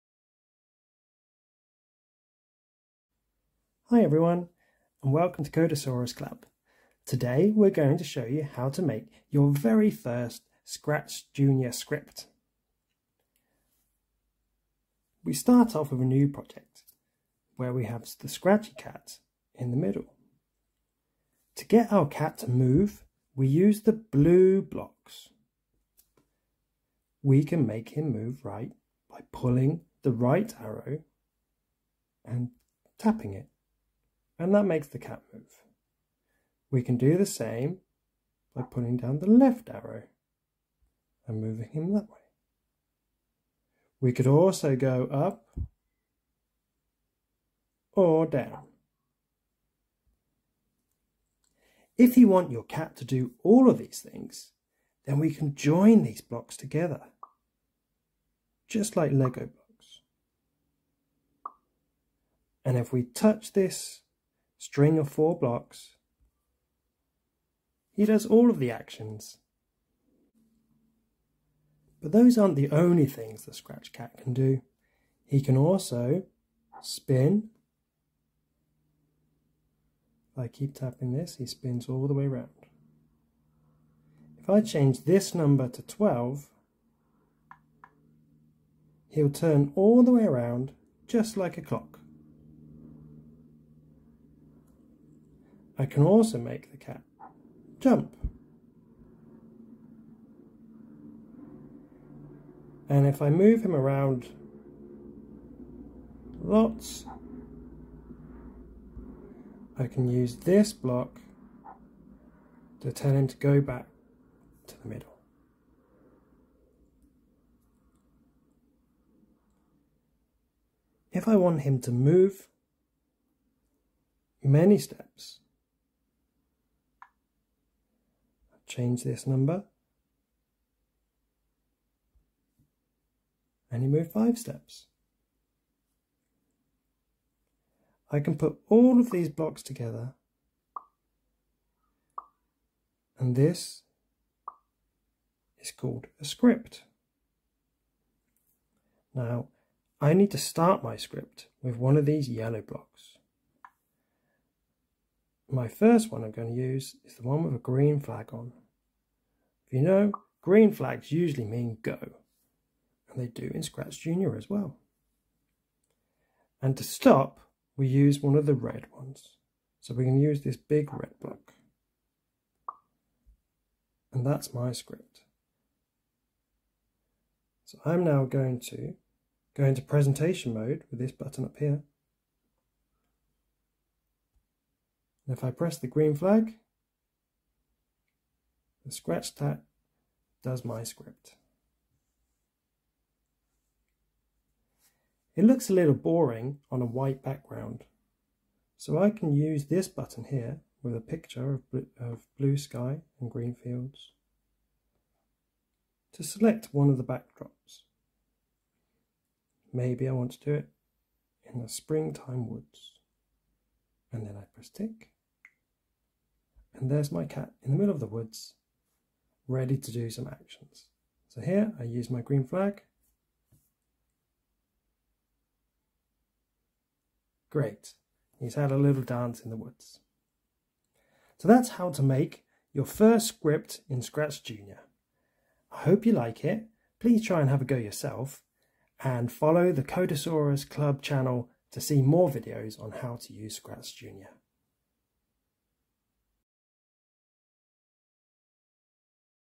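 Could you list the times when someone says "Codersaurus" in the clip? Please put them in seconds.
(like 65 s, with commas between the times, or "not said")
5 s, 239 s.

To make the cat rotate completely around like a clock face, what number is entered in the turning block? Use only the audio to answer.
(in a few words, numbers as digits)
12.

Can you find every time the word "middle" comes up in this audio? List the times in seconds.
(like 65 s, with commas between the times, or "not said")
19 s, 114 s, 217 s.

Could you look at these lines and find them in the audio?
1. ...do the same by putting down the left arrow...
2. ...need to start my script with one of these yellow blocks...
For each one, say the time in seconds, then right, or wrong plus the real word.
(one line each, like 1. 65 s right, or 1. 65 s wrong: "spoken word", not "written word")
1. 36 s right
2. 150 s right.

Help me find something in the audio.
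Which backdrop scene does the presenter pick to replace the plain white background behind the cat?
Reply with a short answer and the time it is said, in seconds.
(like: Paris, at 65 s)
Springtime woods, at 211 s.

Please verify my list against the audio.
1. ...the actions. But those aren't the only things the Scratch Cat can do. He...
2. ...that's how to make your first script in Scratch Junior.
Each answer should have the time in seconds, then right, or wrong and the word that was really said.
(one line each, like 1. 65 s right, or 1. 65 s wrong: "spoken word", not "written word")
1. 68 s right
2. 231 s right.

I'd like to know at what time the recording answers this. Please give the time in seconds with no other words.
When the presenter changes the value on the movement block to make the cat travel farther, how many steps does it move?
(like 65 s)
134 s.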